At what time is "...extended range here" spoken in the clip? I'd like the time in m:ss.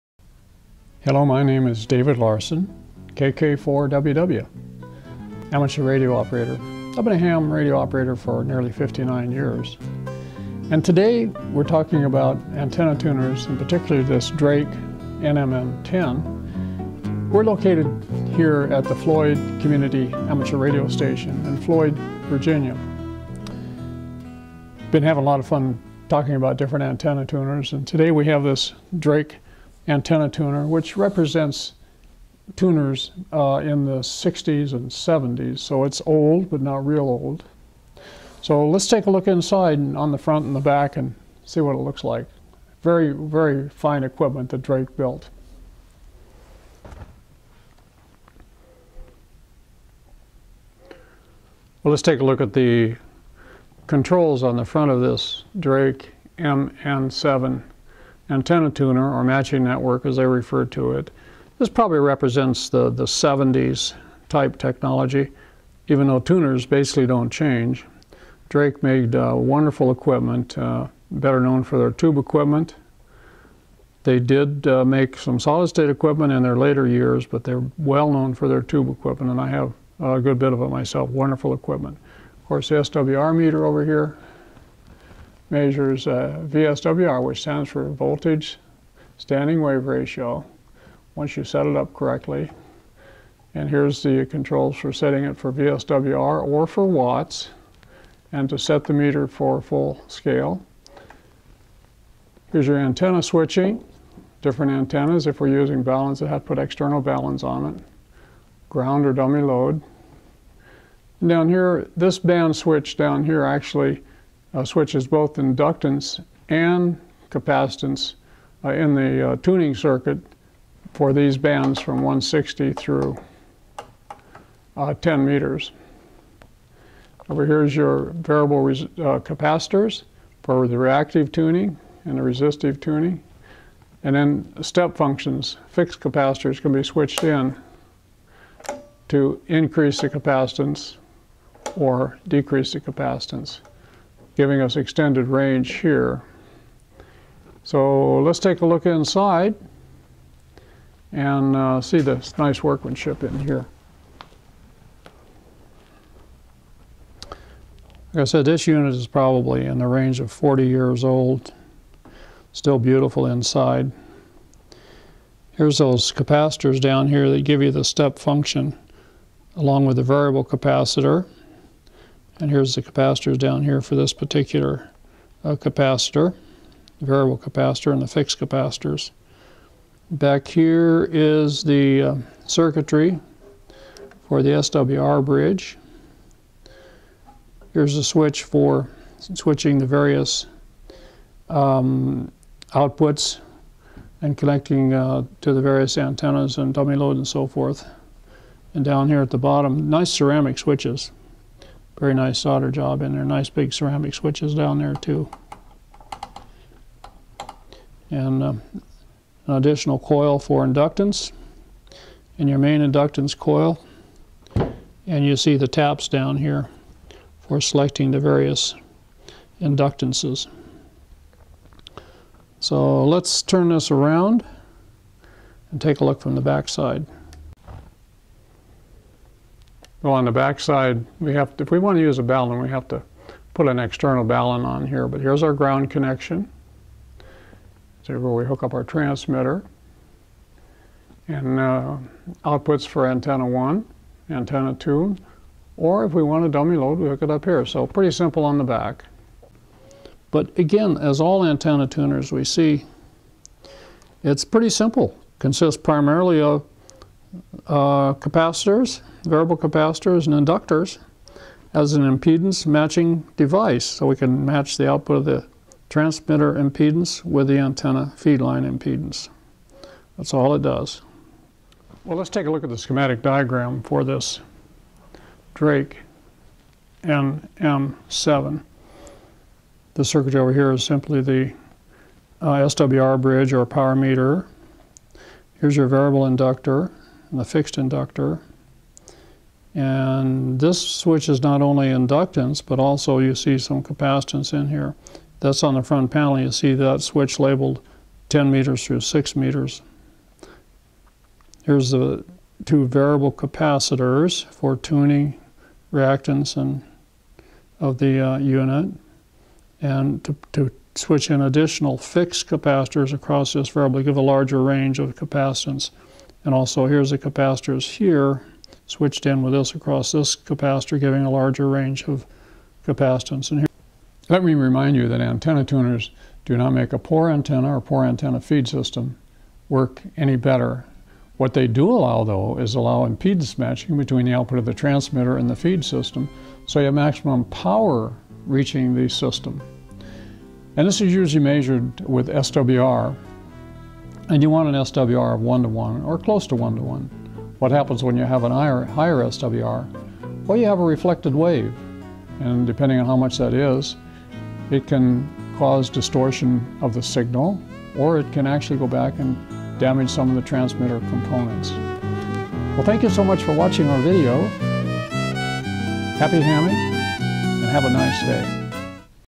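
2:24.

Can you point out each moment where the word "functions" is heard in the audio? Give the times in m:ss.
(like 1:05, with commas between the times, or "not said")
2:14, 2:48.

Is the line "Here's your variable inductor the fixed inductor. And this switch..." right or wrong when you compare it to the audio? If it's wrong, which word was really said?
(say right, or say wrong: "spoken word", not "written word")
right.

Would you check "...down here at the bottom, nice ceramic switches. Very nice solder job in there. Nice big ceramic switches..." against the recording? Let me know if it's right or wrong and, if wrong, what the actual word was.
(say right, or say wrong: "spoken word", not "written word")
right.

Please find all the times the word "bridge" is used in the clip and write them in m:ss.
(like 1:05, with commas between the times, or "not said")
3:05, 4:43.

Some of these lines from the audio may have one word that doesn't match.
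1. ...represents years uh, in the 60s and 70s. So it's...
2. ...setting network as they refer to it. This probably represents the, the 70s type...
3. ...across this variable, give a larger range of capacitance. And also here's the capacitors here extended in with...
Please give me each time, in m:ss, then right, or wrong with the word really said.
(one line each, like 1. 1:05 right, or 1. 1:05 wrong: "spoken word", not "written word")
1. 0:30 wrong: "tuners", not "years"
2. 0:59 wrong: "matching", not "setting"
3. 5:13 wrong: "switched", not "extended".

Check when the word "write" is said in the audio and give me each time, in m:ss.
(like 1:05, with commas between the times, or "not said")
not said.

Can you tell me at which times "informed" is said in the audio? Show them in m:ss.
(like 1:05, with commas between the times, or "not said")
not said.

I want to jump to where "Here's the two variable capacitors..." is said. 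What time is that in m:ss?
5:01.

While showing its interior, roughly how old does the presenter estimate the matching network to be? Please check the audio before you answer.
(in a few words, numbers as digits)
40 years.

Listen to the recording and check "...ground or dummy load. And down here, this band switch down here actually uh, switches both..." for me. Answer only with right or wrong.
right.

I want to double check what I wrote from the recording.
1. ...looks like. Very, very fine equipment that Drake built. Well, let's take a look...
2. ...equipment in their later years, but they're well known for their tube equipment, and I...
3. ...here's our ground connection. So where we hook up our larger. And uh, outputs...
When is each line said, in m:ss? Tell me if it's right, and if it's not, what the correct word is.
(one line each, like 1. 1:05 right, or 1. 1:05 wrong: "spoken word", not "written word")
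1. 0:41 right
2. 1:15 right
3. 3:55 wrong: "transmitter", not "larger".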